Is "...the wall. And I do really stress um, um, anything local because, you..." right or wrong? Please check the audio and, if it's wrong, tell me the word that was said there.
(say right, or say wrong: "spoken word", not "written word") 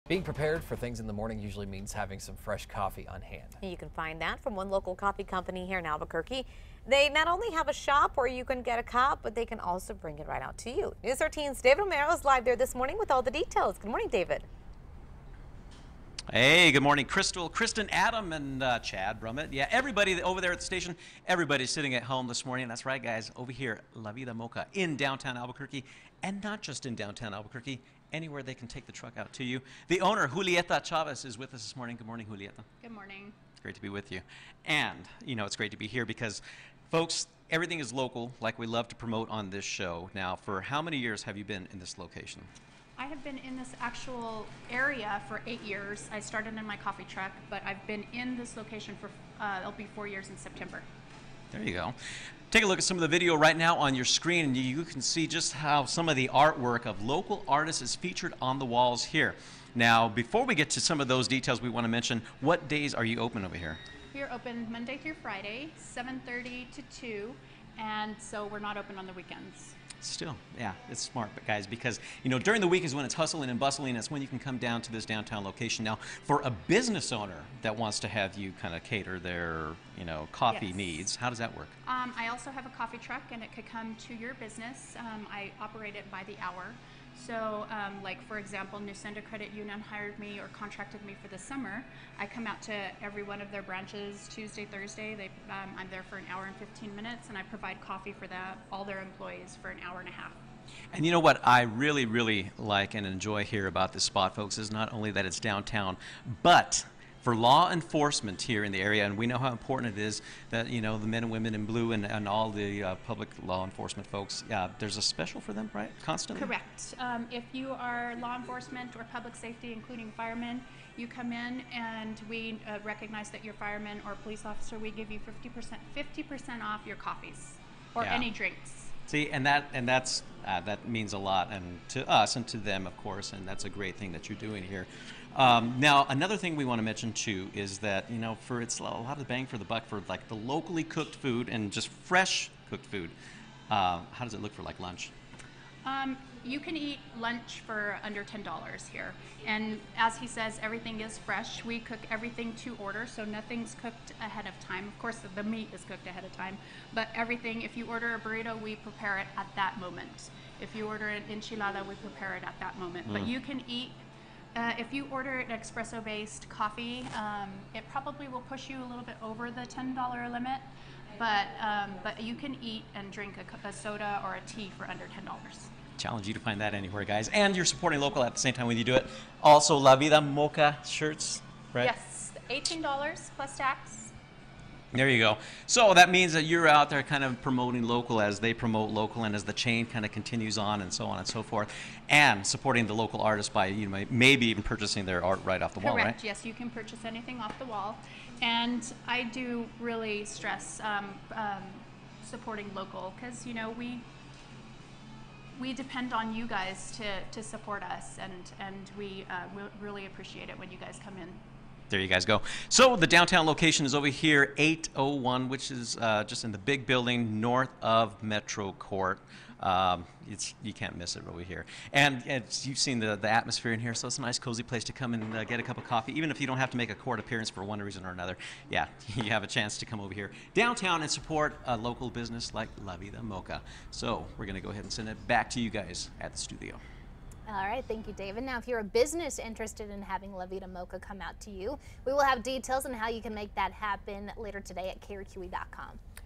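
wrong: "supporting", not "anything".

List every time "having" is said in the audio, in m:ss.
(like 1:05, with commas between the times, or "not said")
0:01, 4:00.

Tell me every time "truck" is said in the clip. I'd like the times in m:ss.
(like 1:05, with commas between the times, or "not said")
0:28, 0:47, 1:22.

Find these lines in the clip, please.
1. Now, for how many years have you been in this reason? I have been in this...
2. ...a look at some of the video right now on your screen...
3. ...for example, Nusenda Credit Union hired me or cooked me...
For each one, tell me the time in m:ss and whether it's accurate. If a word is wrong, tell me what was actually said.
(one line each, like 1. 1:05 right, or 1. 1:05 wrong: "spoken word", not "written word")
1. 0:40 wrong: "location", not "reason"
2. 0:52 right
3. 1:28 wrong: "contracted", not "cooked".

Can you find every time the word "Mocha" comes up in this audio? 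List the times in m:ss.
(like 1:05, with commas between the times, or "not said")
0:24, 3:00, 3:53, 4:00.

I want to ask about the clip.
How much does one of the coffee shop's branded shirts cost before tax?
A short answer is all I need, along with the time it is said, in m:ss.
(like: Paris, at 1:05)
$18, at 3:02.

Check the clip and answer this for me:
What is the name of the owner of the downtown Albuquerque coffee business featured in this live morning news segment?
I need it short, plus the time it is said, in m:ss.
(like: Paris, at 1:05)
Julieta Chavez, at 0:30.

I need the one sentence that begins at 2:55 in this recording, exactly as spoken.
Challenge you to find that anywhere, guys.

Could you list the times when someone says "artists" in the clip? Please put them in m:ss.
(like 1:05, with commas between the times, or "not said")
0:57, 3:13.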